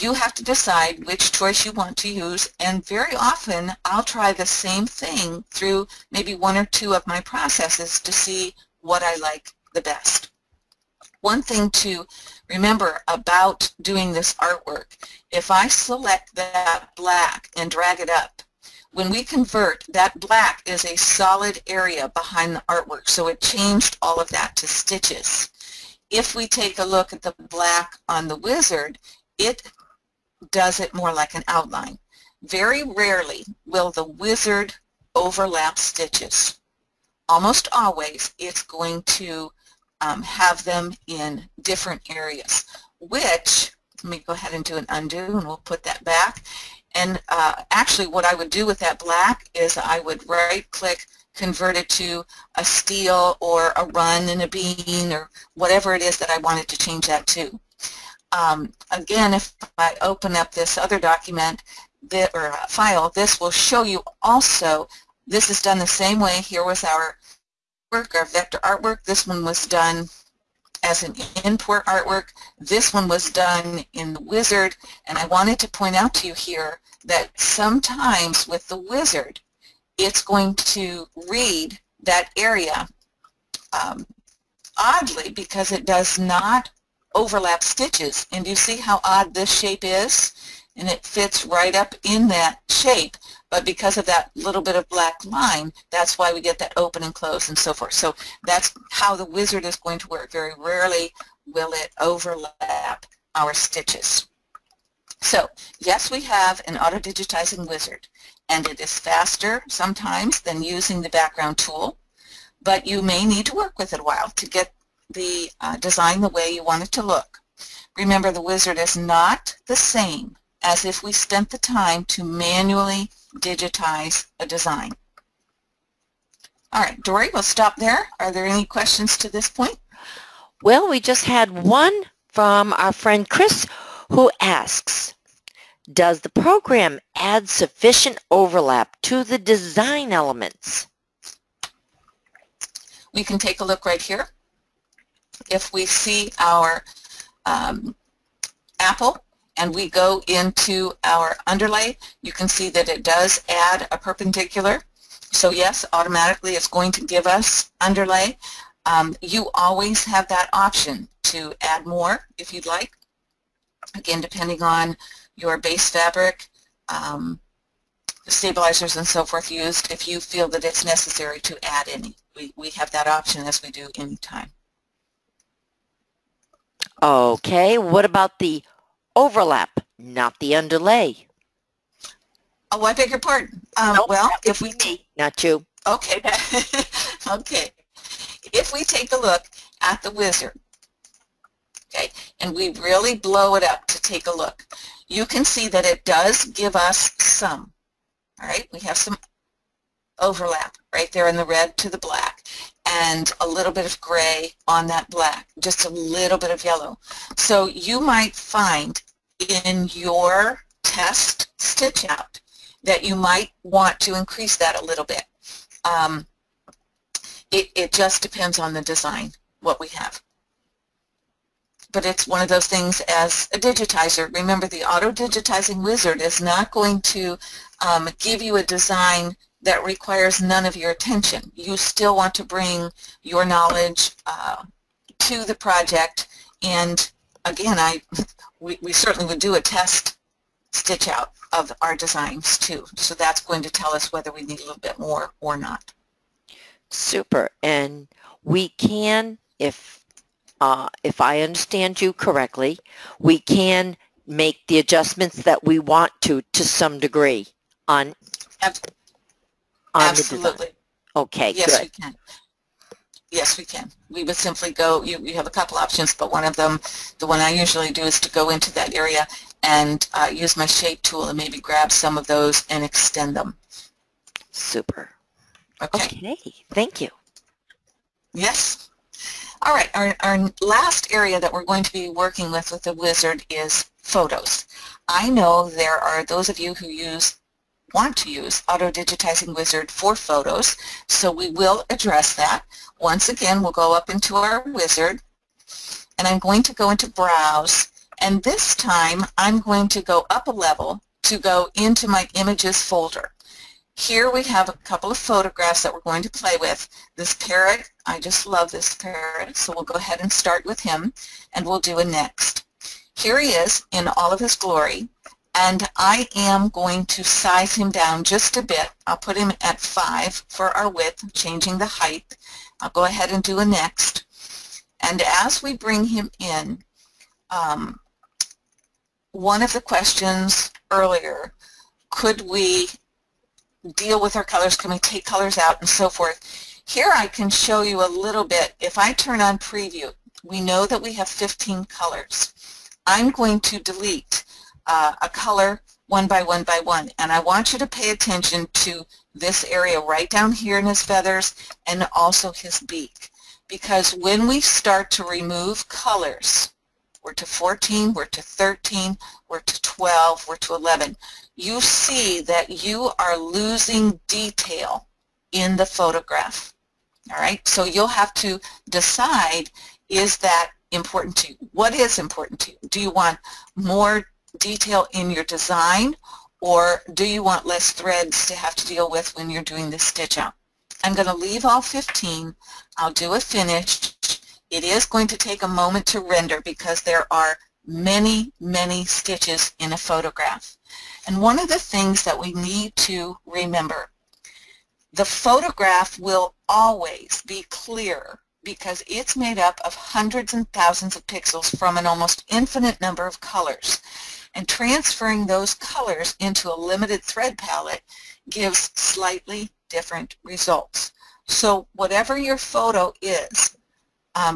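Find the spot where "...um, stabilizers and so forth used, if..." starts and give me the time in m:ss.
2:46.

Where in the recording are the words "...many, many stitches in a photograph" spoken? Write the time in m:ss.
6:27.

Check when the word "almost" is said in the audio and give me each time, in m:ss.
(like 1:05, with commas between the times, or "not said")
0:37, 6:42.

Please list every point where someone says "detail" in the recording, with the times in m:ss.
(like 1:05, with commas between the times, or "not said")
6:04, 6:14.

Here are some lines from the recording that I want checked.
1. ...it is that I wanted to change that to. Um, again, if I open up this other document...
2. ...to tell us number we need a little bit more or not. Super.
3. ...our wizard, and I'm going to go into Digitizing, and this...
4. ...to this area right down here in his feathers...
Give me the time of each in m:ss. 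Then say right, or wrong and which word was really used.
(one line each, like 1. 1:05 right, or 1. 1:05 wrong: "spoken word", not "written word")
1. 0:55 right
2. 4:03 wrong: "whether", not "number"
3. 4:54 wrong: "Browse", not "Digitizing"
4. 5:48 right.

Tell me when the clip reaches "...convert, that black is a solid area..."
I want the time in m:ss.
0:19.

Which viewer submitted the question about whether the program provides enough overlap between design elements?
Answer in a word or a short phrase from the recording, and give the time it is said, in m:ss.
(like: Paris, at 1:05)
Chris, at 2:13.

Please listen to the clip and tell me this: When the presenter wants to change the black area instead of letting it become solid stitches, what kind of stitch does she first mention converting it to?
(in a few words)
steil.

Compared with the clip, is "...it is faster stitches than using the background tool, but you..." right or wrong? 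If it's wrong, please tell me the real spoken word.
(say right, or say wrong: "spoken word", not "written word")
wrong: "sometimes", not "stitches".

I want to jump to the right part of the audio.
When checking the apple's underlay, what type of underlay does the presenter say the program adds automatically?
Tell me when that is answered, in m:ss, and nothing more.
2:33.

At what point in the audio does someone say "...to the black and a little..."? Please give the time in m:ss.
3:21.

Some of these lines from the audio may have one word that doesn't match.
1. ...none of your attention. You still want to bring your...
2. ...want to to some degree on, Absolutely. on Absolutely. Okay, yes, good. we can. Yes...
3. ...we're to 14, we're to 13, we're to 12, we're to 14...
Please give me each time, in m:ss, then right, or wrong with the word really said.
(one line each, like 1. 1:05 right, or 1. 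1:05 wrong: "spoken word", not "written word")
1. 3:50 right
2. 4:15 right
3. 5:57 wrong: "11", not "14".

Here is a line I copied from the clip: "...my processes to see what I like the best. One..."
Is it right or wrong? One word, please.
right.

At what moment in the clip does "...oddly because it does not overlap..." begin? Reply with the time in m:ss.
1:24.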